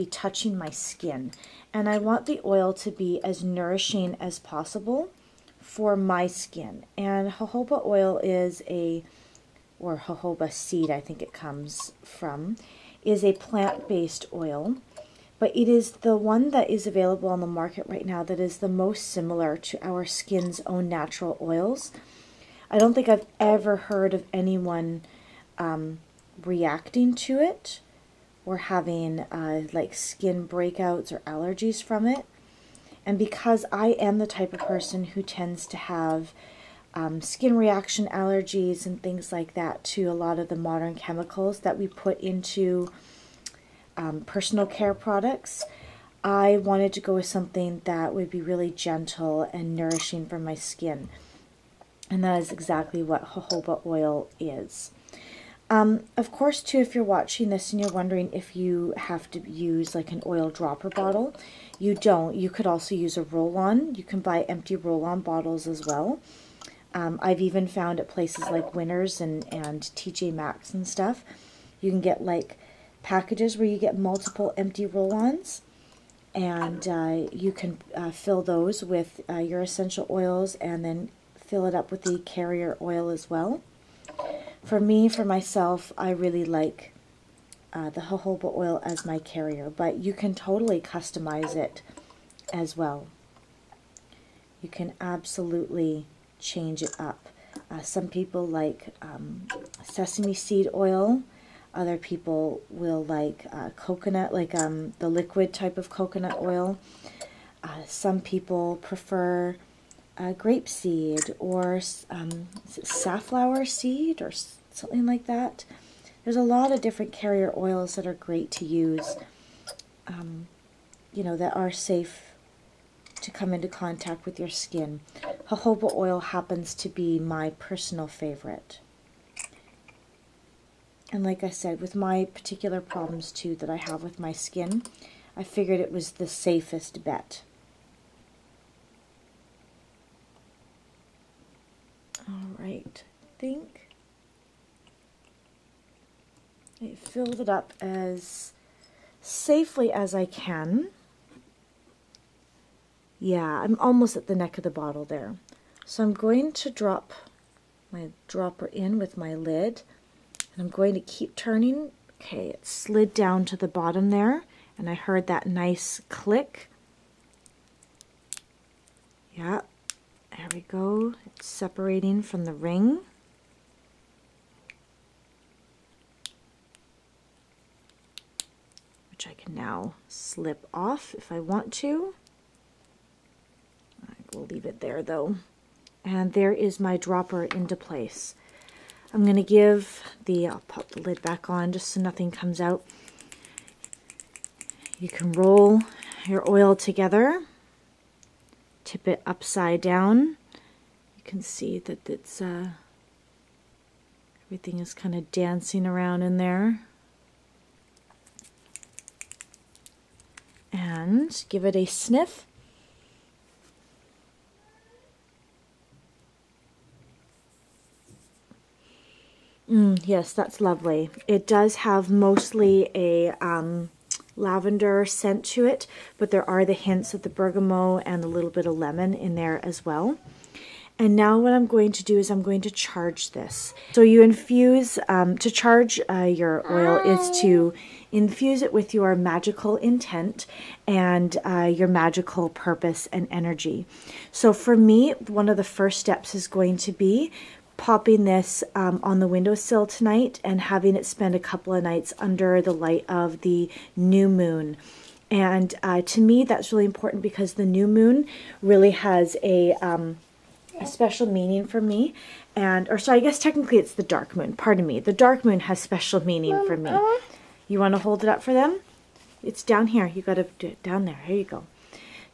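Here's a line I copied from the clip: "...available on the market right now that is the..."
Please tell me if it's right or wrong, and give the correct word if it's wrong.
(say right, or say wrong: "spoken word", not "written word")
right.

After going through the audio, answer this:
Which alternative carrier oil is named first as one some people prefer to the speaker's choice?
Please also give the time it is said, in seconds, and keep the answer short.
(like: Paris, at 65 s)
sesame seed oil, at 99 s.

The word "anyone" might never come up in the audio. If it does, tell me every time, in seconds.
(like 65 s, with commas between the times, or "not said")
24 s.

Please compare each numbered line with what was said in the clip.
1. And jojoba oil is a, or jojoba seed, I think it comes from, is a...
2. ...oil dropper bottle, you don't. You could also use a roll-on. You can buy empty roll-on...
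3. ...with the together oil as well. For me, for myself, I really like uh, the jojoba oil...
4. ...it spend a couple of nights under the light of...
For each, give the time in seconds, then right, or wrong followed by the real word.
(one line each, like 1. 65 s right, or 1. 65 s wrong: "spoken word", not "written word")
1. 6 s right
2. 60 s right
3. 81 s wrong: "carrier", not "together"
4. 250 s right.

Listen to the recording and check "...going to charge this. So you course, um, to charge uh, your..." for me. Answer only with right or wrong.
wrong.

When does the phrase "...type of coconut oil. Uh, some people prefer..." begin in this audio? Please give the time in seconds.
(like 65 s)
105 s.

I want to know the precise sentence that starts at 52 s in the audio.
And that is exactly what jojoba oil is.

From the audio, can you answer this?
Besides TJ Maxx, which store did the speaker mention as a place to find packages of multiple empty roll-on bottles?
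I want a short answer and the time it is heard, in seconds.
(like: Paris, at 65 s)
Winners, at 68 s.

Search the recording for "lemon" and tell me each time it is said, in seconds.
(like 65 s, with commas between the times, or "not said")
228 s.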